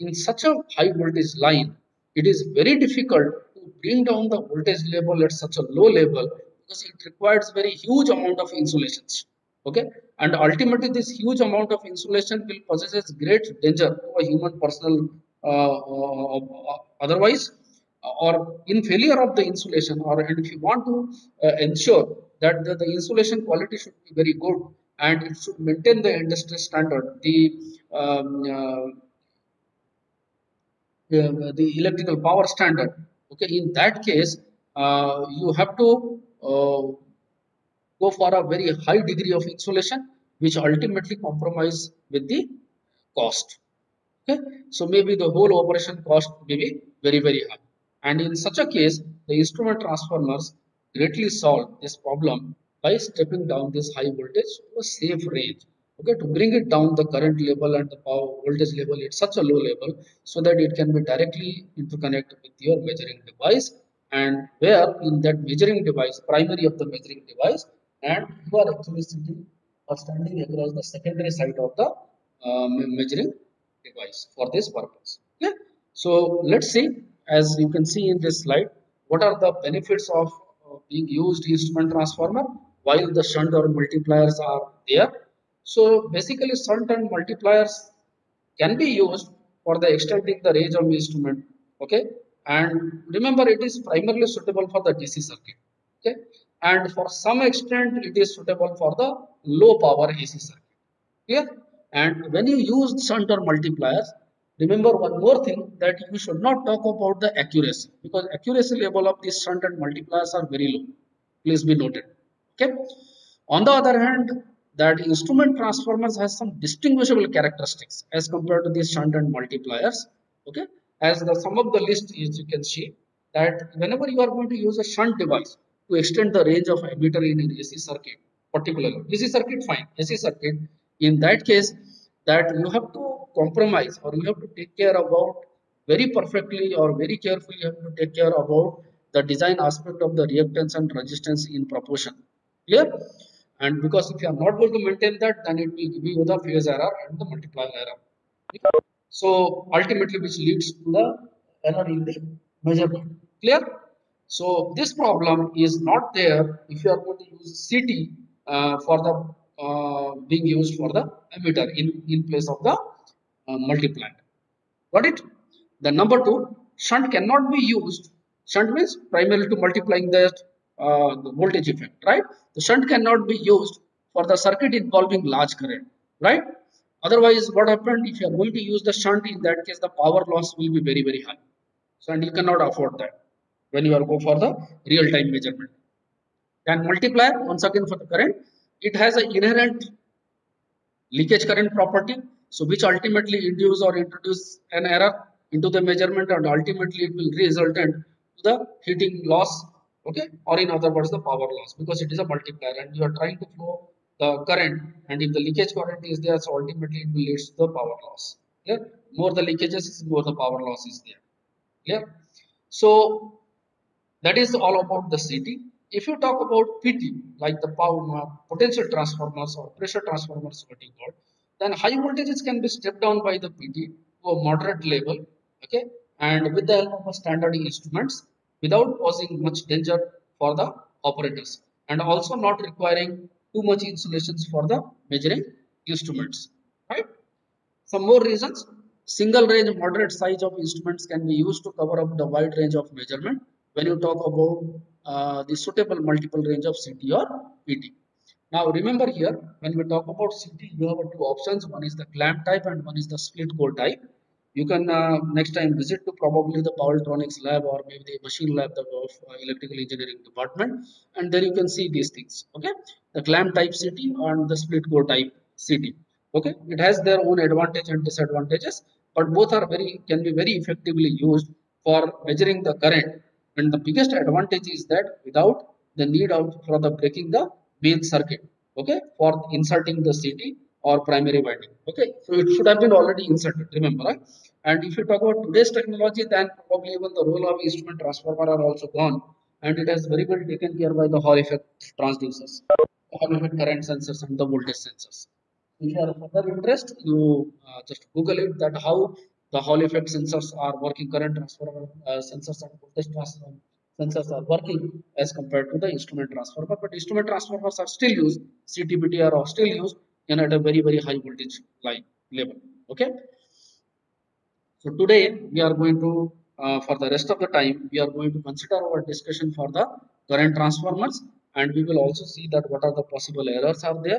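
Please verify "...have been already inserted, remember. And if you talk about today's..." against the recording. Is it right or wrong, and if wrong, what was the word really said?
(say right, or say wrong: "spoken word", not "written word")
right.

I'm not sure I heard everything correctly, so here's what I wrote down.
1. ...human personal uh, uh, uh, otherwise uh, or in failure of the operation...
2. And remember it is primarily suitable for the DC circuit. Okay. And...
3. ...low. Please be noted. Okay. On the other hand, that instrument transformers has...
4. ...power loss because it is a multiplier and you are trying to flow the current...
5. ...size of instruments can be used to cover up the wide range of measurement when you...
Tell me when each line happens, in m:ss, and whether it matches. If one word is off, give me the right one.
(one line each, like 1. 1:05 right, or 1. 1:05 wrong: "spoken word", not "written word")
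1. 0:14 wrong: "insulation", not "operation"
2. 1:32 right
3. 1:50 right
4. 3:21 right
5. 4:00 right.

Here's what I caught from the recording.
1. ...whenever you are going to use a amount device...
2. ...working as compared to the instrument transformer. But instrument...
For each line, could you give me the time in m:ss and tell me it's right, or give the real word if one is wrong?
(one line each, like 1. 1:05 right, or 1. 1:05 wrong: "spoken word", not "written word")
1. 2:03 wrong: "shunt", not "amount"
2. 5:04 right.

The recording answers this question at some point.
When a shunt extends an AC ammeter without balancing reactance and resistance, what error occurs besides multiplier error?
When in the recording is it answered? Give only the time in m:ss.
2:26.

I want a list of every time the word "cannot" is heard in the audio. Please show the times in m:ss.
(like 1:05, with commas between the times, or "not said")
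2:47, 2:52, 3:02.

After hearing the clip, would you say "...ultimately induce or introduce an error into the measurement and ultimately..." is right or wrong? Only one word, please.
right.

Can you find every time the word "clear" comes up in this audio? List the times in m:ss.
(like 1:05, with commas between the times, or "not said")
1:41, 2:22, 2:33.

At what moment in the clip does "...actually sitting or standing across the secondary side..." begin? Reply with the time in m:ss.
1:08.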